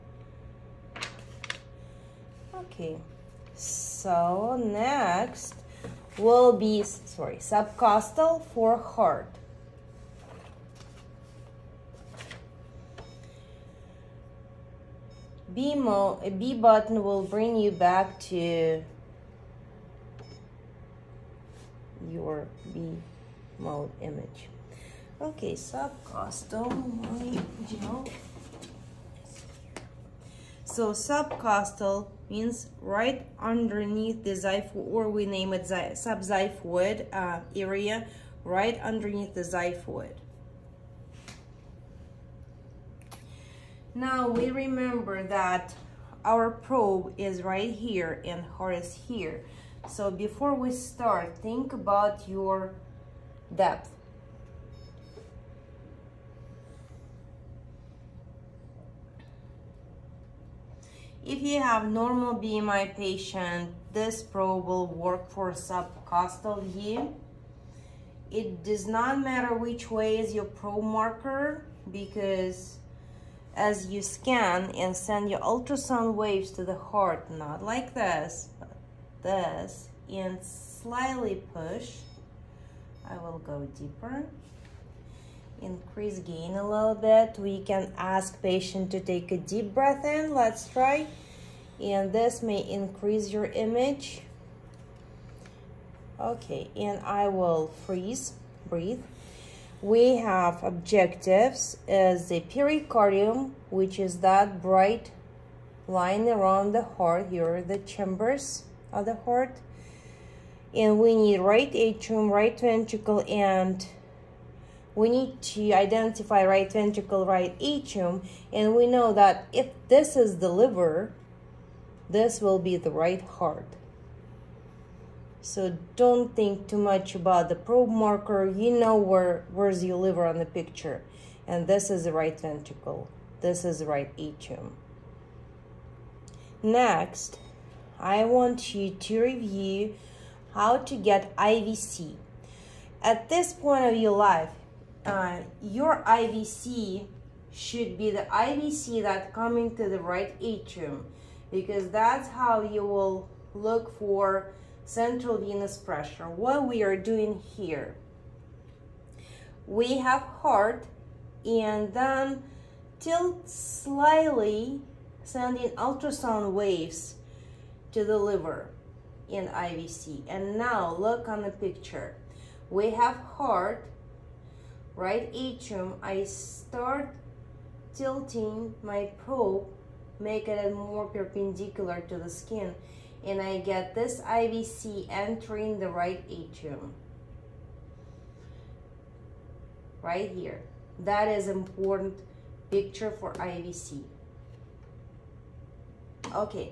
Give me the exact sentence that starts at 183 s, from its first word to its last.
And I get this IVC entering the right atrium.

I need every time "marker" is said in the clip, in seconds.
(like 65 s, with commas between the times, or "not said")
70 s, 127 s.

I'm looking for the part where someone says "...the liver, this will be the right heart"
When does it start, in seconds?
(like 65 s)
120 s.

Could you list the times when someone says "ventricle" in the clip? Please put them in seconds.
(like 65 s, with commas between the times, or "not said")
112 s, 116 s, 132 s.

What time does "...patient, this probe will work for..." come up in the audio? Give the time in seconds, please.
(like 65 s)
62 s.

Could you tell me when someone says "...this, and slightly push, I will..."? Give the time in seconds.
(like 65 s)
79 s.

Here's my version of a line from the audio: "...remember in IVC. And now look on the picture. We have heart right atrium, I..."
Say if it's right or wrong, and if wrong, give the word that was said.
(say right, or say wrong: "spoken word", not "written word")
wrong: "liver", not "remember".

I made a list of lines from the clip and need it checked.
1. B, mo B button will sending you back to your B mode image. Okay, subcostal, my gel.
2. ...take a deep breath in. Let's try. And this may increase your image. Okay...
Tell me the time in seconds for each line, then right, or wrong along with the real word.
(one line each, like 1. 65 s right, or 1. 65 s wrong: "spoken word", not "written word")
1. 15 s wrong: "bring", not "sending"
2. 88 s right.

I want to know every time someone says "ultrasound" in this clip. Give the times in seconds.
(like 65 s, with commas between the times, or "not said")
75 s, 165 s.